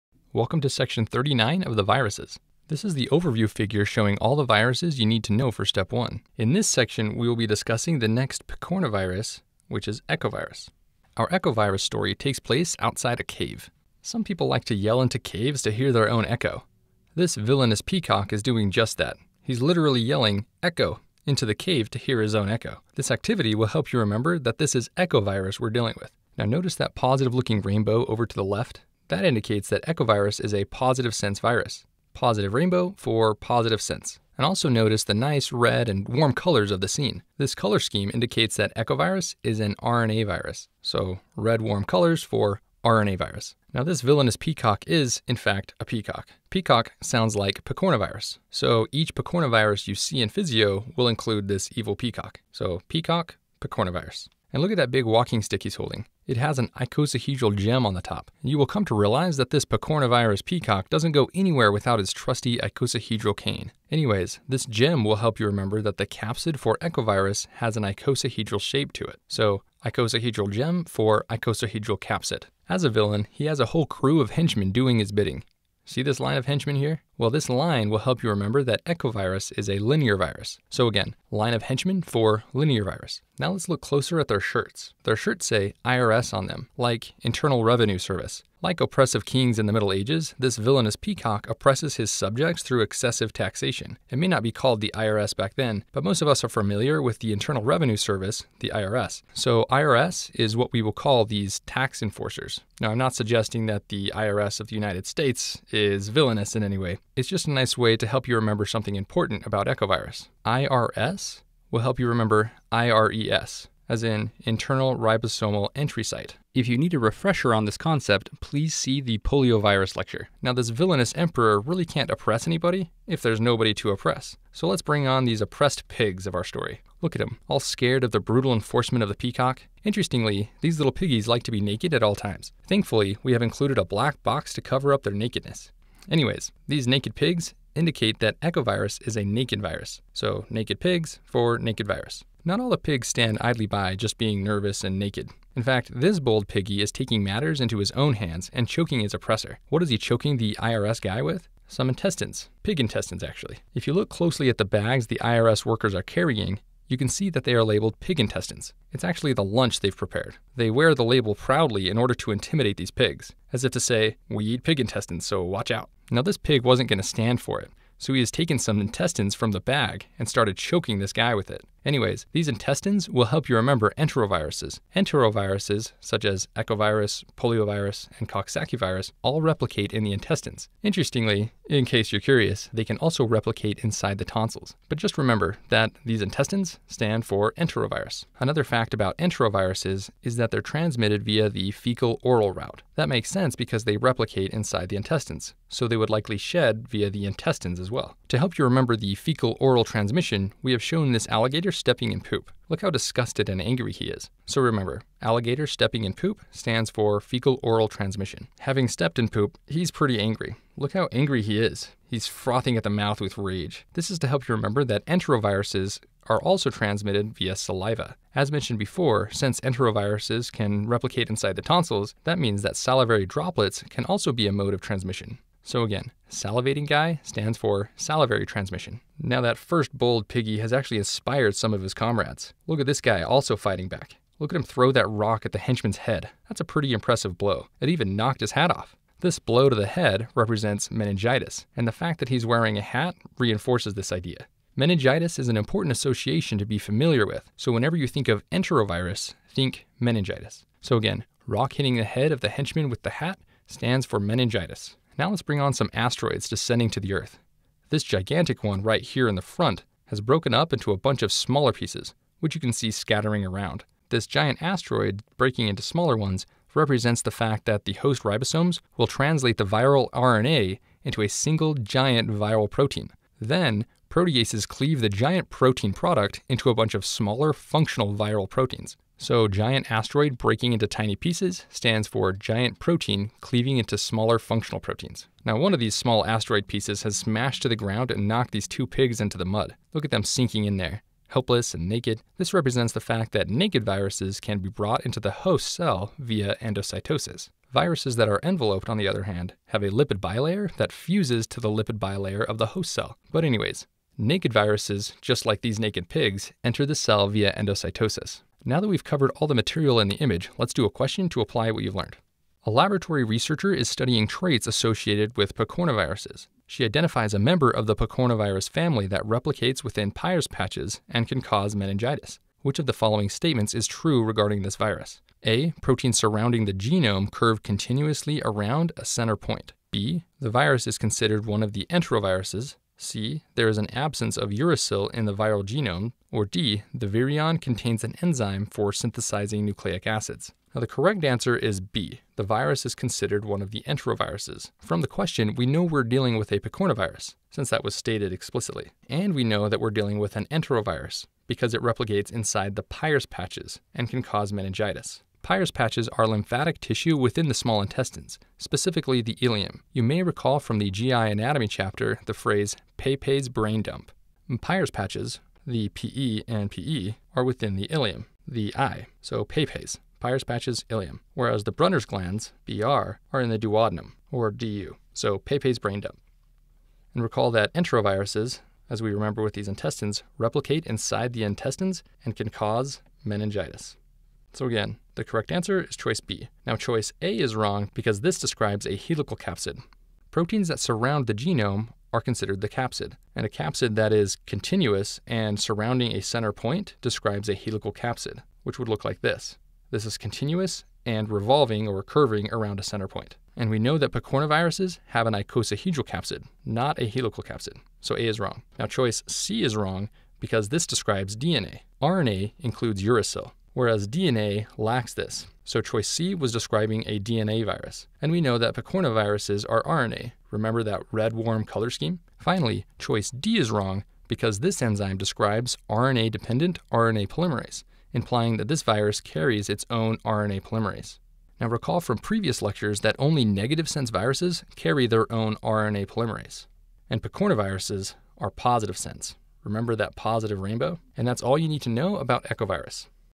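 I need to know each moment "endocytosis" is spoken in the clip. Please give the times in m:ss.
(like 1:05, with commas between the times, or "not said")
4:56, 5:07.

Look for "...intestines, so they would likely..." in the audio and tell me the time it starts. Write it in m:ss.
3:14.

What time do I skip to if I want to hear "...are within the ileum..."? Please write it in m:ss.
6:07.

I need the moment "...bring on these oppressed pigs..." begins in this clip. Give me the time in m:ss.
2:04.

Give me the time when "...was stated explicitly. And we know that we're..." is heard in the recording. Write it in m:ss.
5:47.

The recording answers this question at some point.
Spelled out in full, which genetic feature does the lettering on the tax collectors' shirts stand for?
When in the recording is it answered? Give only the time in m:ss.
1:54.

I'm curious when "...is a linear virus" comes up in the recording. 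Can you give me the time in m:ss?
1:19.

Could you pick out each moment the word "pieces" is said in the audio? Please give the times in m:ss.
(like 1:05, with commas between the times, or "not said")
4:21, 4:41, 4:46.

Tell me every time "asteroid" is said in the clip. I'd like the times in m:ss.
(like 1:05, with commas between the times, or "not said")
4:15, 4:24, 4:39, 4:46.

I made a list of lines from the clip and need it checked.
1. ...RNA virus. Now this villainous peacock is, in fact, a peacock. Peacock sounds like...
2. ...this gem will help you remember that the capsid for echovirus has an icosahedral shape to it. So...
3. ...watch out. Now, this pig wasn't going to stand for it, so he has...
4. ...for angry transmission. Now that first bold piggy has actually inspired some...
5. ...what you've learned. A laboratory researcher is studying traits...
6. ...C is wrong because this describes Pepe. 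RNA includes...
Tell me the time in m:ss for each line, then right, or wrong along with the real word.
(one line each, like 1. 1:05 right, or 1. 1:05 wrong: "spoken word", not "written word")
1. 0:42 right
2. 1:04 right
3. 2:45 right
4. 3:47 wrong: "salivary", not "angry"
5. 5:11 right
6. 6:49 wrong: "DNA", not "Pepe".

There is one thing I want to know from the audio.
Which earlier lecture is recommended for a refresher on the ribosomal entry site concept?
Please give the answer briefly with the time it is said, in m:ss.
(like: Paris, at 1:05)
Poliovirus lecture, at 1:59.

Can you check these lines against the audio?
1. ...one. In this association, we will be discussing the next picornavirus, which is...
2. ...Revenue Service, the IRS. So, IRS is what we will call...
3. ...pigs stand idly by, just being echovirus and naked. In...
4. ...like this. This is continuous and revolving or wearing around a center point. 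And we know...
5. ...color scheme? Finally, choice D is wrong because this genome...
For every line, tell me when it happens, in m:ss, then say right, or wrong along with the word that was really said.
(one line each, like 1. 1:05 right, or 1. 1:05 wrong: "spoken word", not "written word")
1. 0:05 wrong: "section", not "association"
2. 1:37 right
3. 2:22 wrong: "nervous", not "echovirus"
4. 6:39 wrong: "curving", not "wearing"
5. 7:01 wrong: "enzyme", not "genome".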